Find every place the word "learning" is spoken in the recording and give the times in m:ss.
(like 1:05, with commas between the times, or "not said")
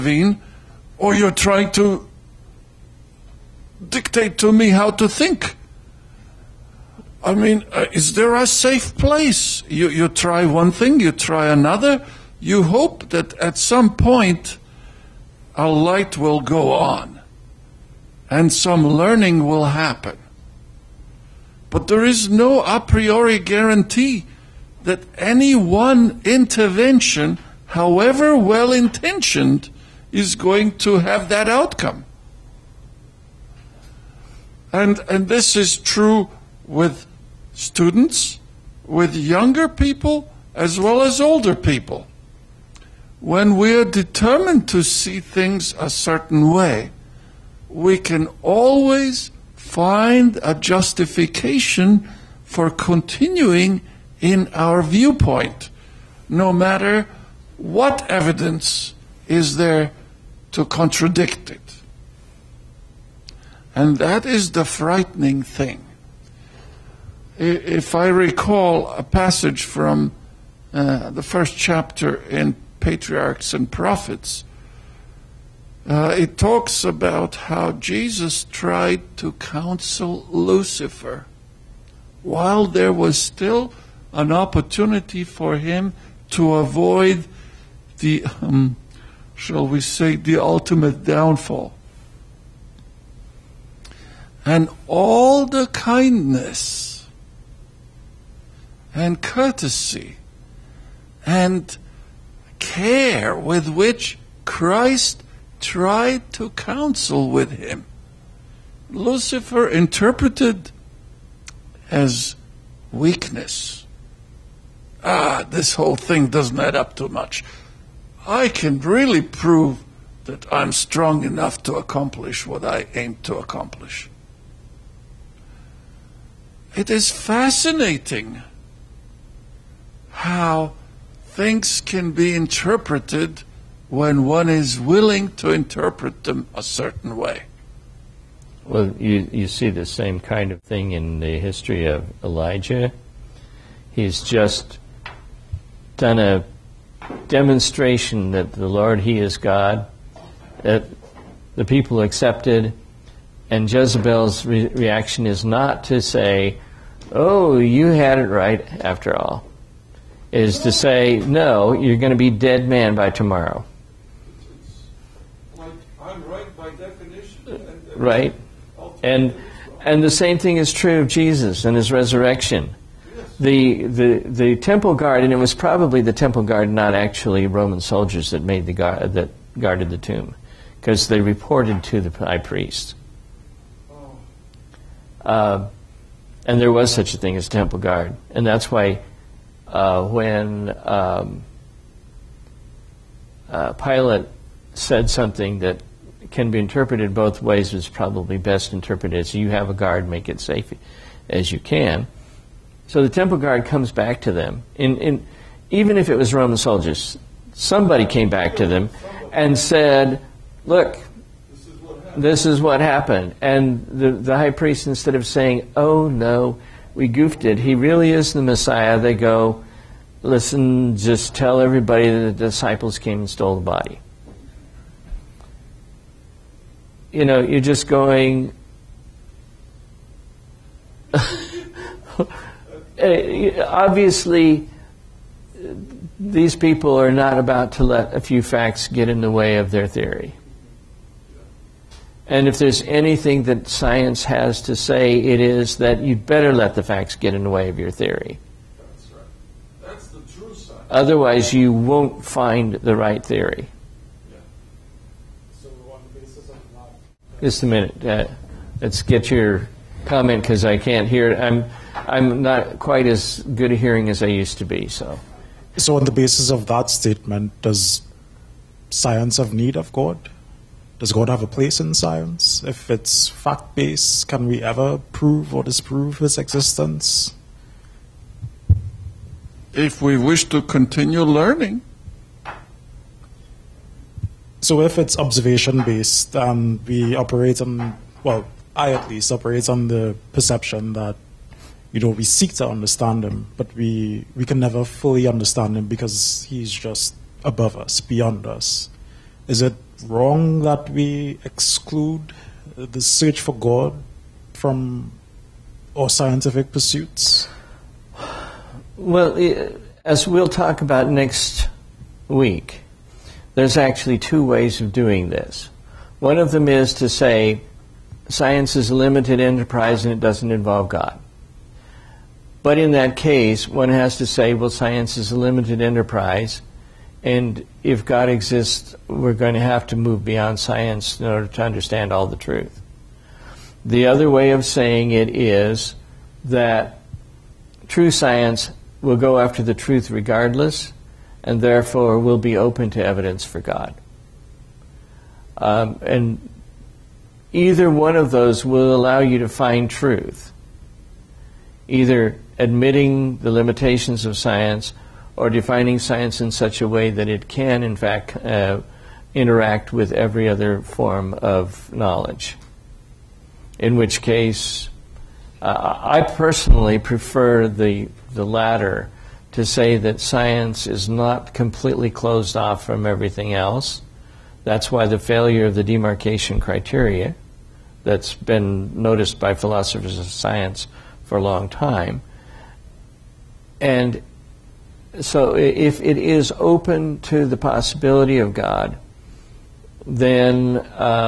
0:18, 4:41.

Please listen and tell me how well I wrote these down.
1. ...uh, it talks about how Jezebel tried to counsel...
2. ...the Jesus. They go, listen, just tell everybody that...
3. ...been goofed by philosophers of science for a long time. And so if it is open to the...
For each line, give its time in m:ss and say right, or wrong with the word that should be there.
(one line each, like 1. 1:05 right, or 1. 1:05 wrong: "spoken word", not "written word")
1. 1:15 wrong: "Jesus", not "Jezebel"
2. 3:38 wrong: "Messiah", not "Jesus"
3. 6:18 wrong: "noticed", not "goofed".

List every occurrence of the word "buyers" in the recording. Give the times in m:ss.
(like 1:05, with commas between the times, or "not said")
not said.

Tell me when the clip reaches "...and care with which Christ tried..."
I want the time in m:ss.
1:41.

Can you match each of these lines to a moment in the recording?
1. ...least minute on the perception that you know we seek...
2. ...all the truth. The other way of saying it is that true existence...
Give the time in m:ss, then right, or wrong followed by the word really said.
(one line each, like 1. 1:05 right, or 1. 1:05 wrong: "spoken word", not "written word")
1. 4:49 wrong: "operate", not "minute"
2. 5:32 wrong: "science", not "existence".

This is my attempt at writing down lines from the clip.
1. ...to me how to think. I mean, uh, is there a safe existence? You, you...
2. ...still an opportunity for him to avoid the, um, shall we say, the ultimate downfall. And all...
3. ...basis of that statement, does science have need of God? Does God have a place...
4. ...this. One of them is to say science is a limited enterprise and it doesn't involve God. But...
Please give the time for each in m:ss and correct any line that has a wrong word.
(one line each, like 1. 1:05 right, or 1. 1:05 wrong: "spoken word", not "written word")
1. 0:04 wrong: "place", not "existence"
2. 1:23 right
3. 4:26 right
4. 5:15 right.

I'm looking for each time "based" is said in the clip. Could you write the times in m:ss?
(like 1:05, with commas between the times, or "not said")
4:33, 4:45.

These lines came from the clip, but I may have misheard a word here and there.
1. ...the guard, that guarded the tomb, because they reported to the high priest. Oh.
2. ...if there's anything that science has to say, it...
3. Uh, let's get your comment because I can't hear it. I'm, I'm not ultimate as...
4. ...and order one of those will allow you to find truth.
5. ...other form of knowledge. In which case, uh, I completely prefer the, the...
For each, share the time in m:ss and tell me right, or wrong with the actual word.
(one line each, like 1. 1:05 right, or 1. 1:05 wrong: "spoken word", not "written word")
1. 2:58 right
2. 4:02 right
3. 4:18 wrong: "quite", not "ultimate"
4. 5:46 wrong: "either", not "order"
5. 6:00 wrong: "personally", not "completely".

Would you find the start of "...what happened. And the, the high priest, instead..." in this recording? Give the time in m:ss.
3:32.